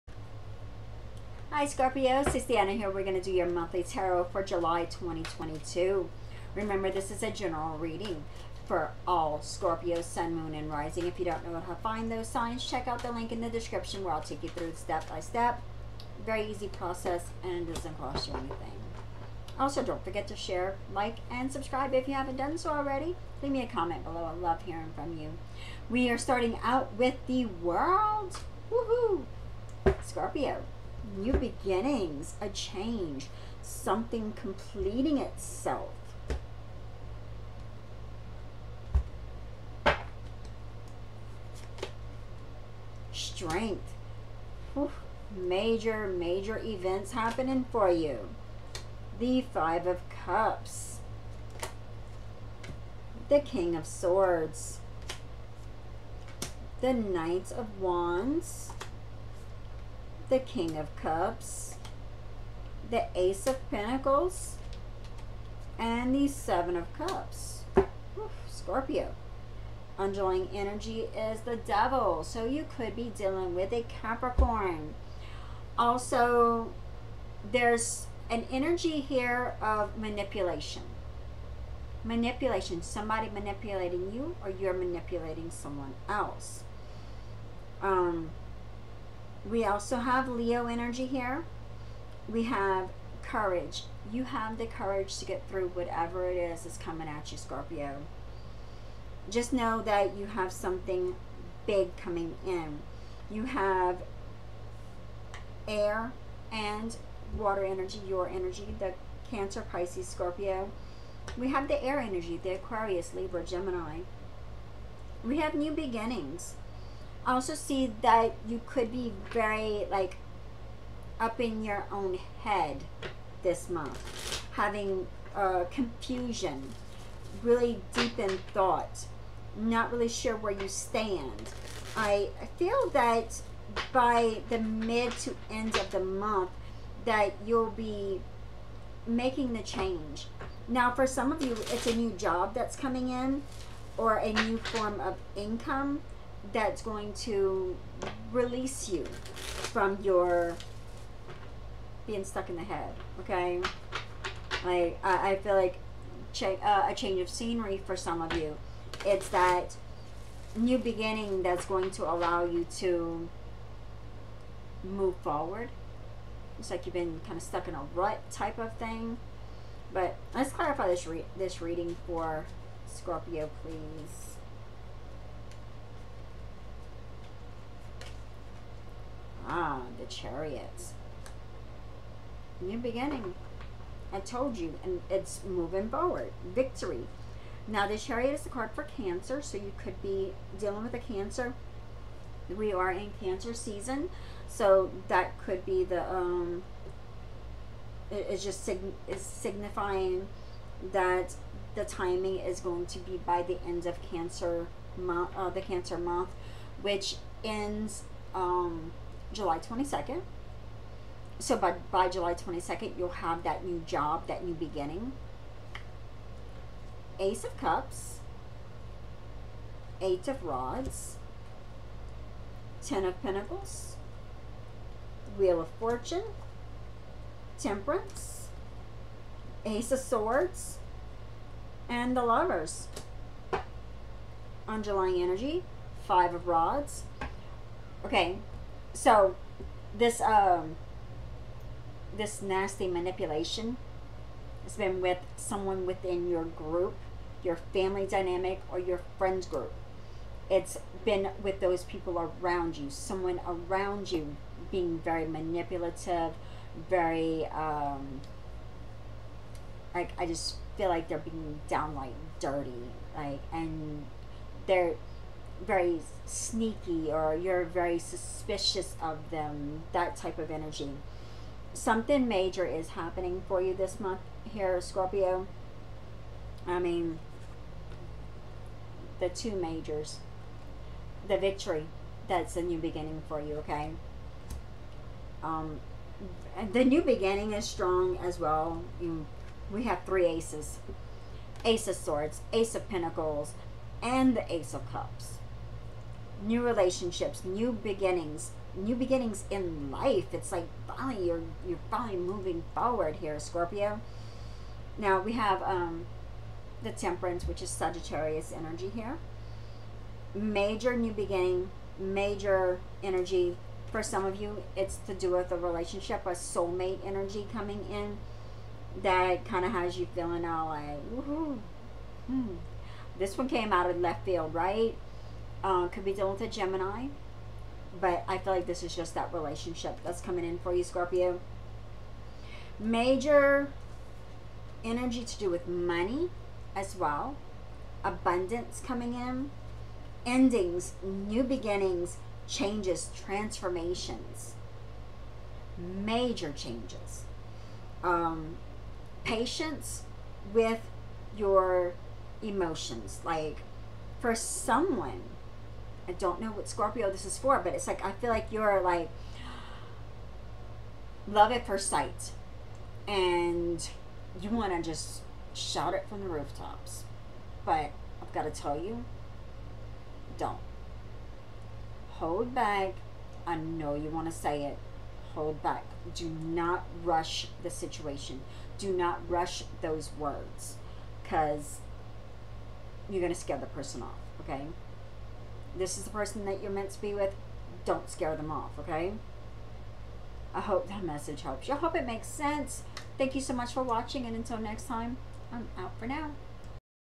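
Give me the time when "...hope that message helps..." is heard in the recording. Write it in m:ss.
6:30.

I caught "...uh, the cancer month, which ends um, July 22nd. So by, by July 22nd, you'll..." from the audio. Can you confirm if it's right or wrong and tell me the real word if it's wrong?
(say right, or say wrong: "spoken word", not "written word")
right.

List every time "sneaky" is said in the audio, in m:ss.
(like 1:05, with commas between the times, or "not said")
4:26.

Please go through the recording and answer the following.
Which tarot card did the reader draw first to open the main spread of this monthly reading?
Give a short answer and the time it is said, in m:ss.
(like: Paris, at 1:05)
The World, at 0:27.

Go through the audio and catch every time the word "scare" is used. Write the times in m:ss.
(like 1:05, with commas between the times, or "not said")
6:23, 6:28.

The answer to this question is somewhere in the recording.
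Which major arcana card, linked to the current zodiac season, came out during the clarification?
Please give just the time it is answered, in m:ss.
2:59.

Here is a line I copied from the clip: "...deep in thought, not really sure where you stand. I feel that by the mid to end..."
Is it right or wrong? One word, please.
right.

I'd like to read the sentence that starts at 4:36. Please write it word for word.
I mean, the two majors, the victory, that's a new beginning for you, okay?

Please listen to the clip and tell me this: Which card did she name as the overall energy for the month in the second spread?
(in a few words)
Five of Rods.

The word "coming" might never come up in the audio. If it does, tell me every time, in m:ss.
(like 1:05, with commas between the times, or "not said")
1:36, 1:41, 2:22, 5:17, 5:30, 5:38.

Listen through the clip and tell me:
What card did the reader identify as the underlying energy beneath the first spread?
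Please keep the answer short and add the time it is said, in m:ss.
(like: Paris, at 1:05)
The Devil, at 1:11.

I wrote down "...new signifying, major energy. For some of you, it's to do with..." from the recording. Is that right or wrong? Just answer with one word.
wrong.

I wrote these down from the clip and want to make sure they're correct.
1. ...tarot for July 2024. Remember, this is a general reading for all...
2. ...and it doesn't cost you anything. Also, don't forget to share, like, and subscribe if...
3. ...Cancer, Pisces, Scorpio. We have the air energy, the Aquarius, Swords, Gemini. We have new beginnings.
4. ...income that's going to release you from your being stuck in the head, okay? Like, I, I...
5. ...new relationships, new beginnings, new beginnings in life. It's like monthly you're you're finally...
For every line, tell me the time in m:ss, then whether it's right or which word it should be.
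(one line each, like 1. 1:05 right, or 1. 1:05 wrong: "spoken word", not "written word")
1. 0:03 wrong: "2022", not "2024"
2. 0:17 right
3. 1:49 wrong: "Libra", not "Swords"
4. 2:25 right
5. 4:56 wrong: "finally", not "monthly".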